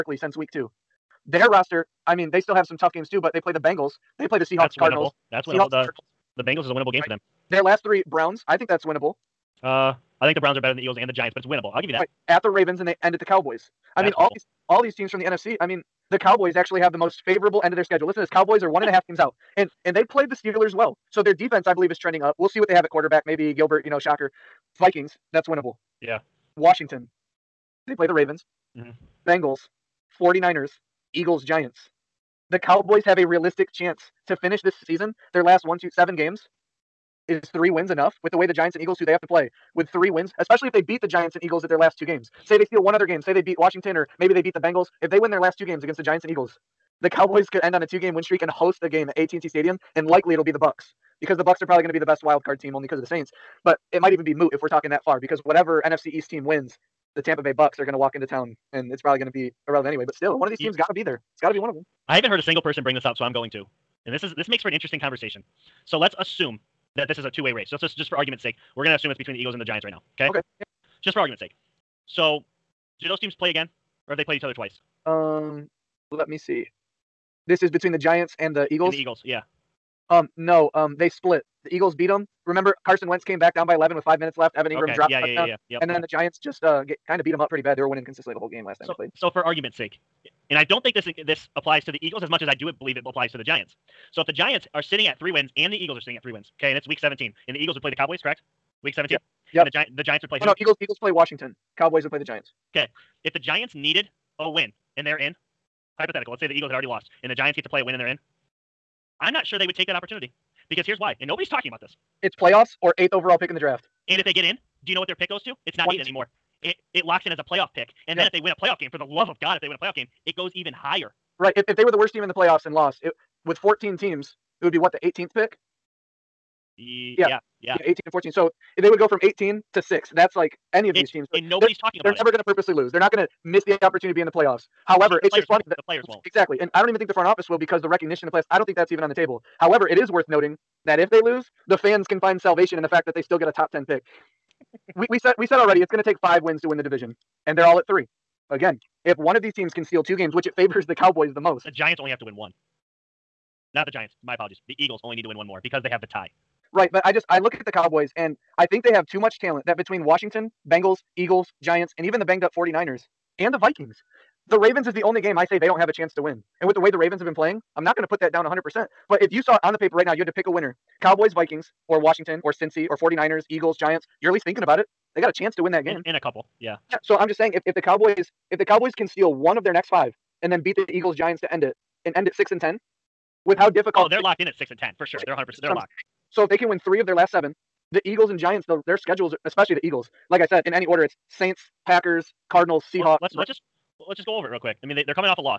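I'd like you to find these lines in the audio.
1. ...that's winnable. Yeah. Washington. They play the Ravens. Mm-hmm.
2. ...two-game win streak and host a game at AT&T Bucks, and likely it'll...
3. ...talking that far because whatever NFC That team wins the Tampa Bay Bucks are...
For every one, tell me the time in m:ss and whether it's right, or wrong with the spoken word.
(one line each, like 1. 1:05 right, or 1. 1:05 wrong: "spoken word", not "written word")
1. 0:25 right
2. 0:47 wrong: "Stadium", not "Bucks"
3. 0:54 wrong: "East", not "That".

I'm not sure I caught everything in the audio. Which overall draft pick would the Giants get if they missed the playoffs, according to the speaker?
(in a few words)
8th.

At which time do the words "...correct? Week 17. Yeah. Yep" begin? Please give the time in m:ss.
1:38.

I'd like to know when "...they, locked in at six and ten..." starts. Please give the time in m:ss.
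3:04.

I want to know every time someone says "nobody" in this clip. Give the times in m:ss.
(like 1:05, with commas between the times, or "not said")
1:51, 2:11.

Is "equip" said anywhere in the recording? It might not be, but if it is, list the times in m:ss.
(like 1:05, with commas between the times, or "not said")
not said.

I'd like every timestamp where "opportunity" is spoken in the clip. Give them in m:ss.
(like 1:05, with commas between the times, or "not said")
1:49, 2:13.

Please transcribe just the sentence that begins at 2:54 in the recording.
You're at least thinking about it.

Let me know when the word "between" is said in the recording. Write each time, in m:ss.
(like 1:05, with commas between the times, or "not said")
1:09, 1:17, 2:39.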